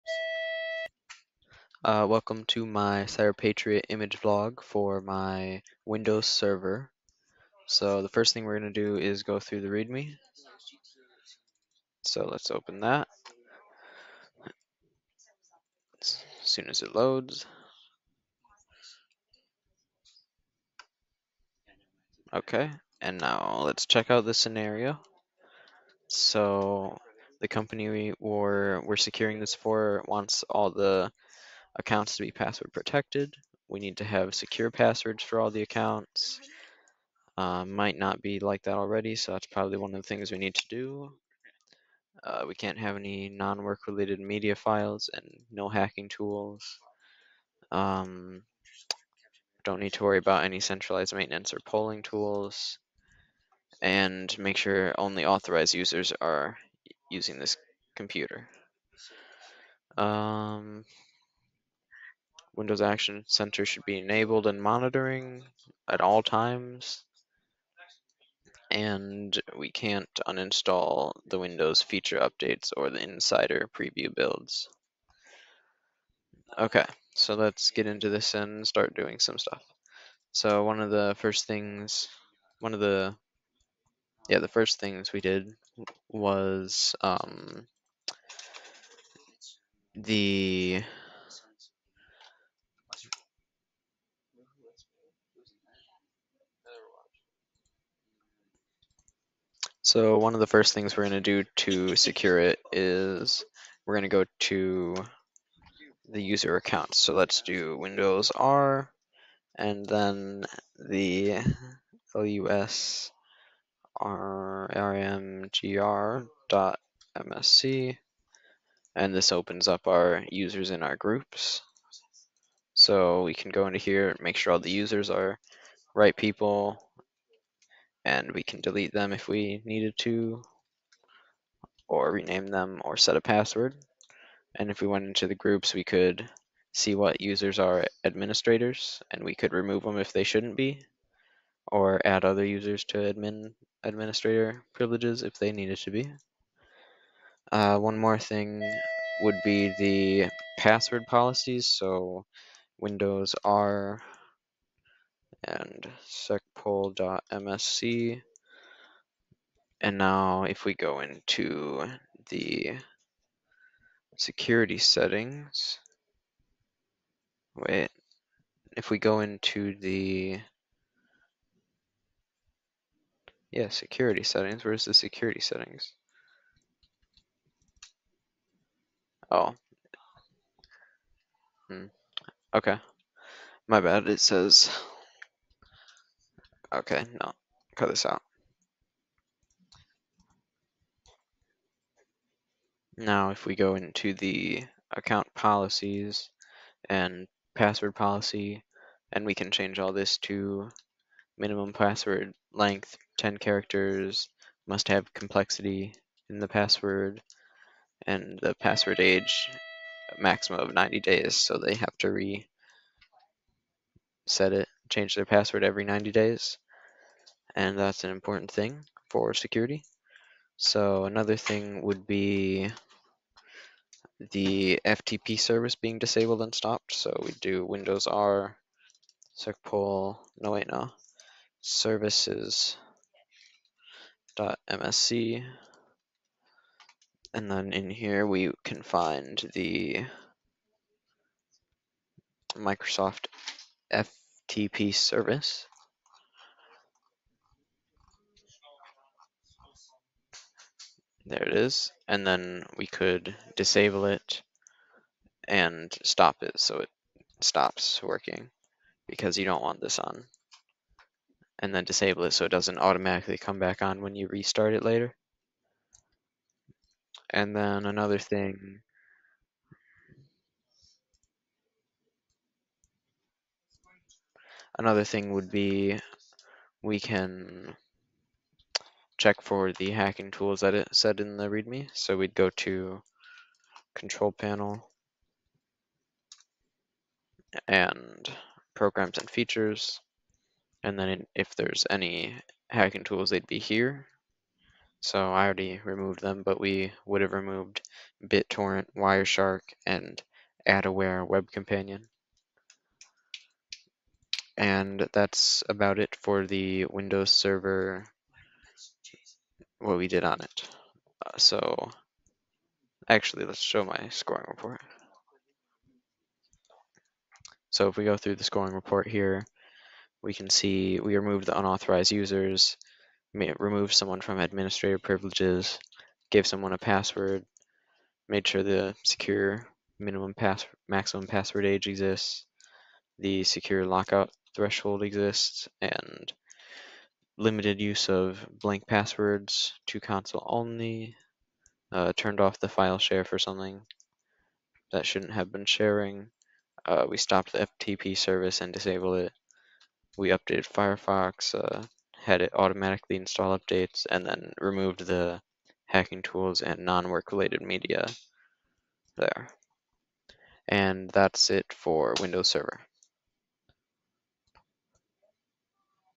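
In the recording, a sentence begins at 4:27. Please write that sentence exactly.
And then another thing Another thing would be we can check for the hacking tools that it said in the README.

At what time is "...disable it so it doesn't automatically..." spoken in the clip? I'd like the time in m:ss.
4:21.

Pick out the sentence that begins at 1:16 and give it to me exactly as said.
Okay, so let's get into this and start doing some stuff.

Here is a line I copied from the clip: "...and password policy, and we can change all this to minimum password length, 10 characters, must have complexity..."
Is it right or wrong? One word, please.
right.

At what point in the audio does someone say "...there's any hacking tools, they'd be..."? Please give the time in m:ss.
4:51.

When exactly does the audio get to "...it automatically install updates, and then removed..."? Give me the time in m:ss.
5:52.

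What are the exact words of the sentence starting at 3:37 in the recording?
And that's an important thing for security.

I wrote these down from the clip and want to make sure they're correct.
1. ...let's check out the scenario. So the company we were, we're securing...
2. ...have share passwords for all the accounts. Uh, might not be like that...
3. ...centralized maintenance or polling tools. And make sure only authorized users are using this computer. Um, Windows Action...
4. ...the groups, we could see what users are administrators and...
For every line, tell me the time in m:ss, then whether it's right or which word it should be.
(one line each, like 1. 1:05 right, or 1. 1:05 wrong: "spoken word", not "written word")
1. 0:23 right
2. 0:34 wrong: "secure", not "share"
3. 0:50 right
4. 2:15 right.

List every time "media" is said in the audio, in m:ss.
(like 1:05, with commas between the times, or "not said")
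0:44, 5:57.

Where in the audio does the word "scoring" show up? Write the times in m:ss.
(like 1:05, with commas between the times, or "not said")
5:14, 5:18.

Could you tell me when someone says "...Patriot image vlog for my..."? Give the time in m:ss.
0:03.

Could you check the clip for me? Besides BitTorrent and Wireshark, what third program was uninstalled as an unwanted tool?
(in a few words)
AdAware Web Companion.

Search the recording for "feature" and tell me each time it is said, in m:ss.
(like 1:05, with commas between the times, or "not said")
1:11, 4:49.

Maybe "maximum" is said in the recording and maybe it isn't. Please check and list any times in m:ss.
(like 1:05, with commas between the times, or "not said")
3:30, 5:30.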